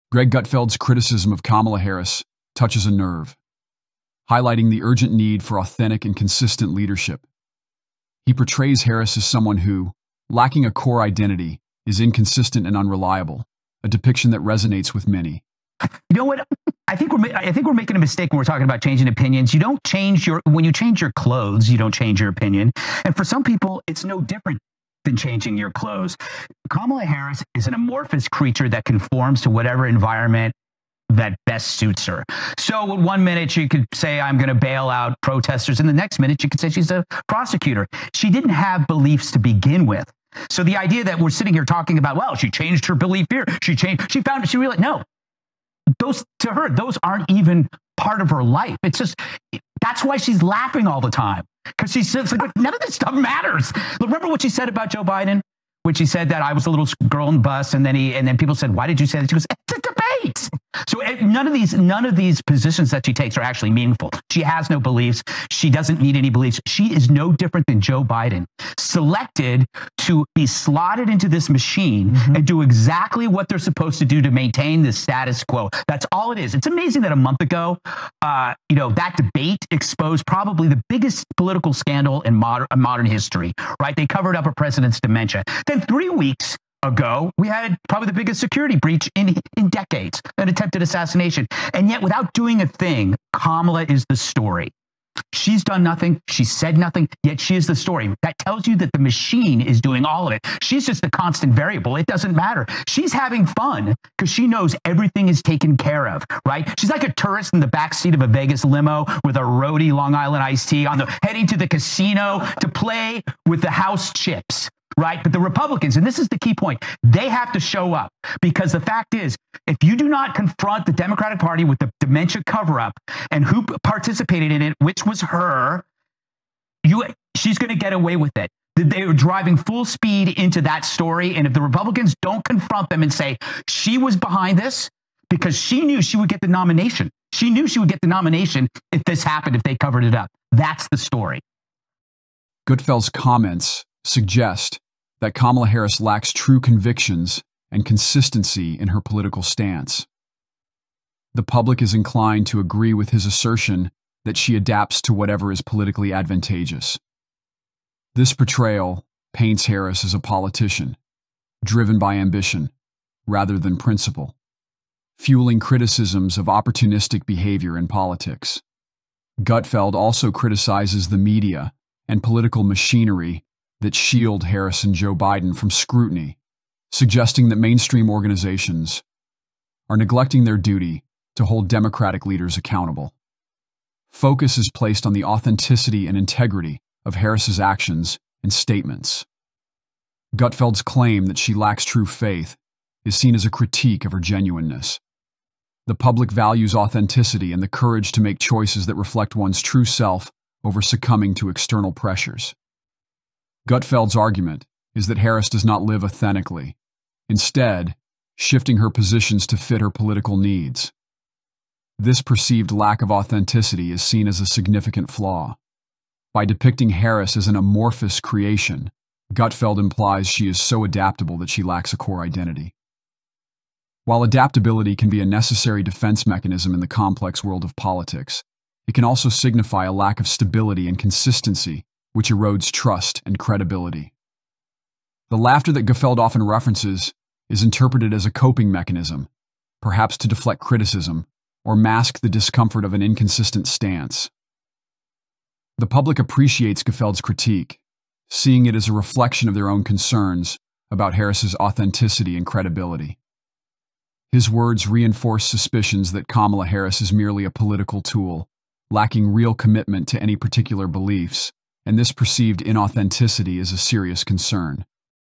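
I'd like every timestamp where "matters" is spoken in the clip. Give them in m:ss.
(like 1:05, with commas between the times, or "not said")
0:53, 1:42.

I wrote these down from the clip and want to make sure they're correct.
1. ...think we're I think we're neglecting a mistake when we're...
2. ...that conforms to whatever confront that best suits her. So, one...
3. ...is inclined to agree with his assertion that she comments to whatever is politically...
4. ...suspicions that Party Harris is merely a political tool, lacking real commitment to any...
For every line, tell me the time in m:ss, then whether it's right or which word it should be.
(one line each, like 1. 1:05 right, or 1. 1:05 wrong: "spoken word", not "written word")
1. 0:16 wrong: "making", not "neglecting"
2. 0:28 wrong: "environment", not "confront"
3. 2:31 wrong: "adapts", not "comments"
4. 4:15 wrong: "Kamala", not "Party".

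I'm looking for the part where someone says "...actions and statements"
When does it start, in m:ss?
3:07.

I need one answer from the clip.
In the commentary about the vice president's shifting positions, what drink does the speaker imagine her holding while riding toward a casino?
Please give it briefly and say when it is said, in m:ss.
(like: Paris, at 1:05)
Long Island iced tea, at 1:49.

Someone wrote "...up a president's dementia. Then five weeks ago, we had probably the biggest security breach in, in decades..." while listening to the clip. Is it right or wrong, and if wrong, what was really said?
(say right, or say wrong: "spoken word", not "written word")
wrong: "three", not "five".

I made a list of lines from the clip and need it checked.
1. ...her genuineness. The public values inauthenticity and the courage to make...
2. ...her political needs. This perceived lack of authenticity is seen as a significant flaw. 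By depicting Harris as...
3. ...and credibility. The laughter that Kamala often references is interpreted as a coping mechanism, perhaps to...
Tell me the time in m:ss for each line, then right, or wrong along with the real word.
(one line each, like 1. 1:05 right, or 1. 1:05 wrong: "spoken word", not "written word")
1. 3:14 wrong: "authenticity", not "inauthenticity"
2. 3:29 right
3. 3:53 wrong: "Gutfeld", not "Kamala".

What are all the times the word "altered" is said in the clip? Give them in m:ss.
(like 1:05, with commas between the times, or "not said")
not said.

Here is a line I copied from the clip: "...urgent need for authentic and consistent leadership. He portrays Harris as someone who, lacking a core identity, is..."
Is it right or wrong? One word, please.
right.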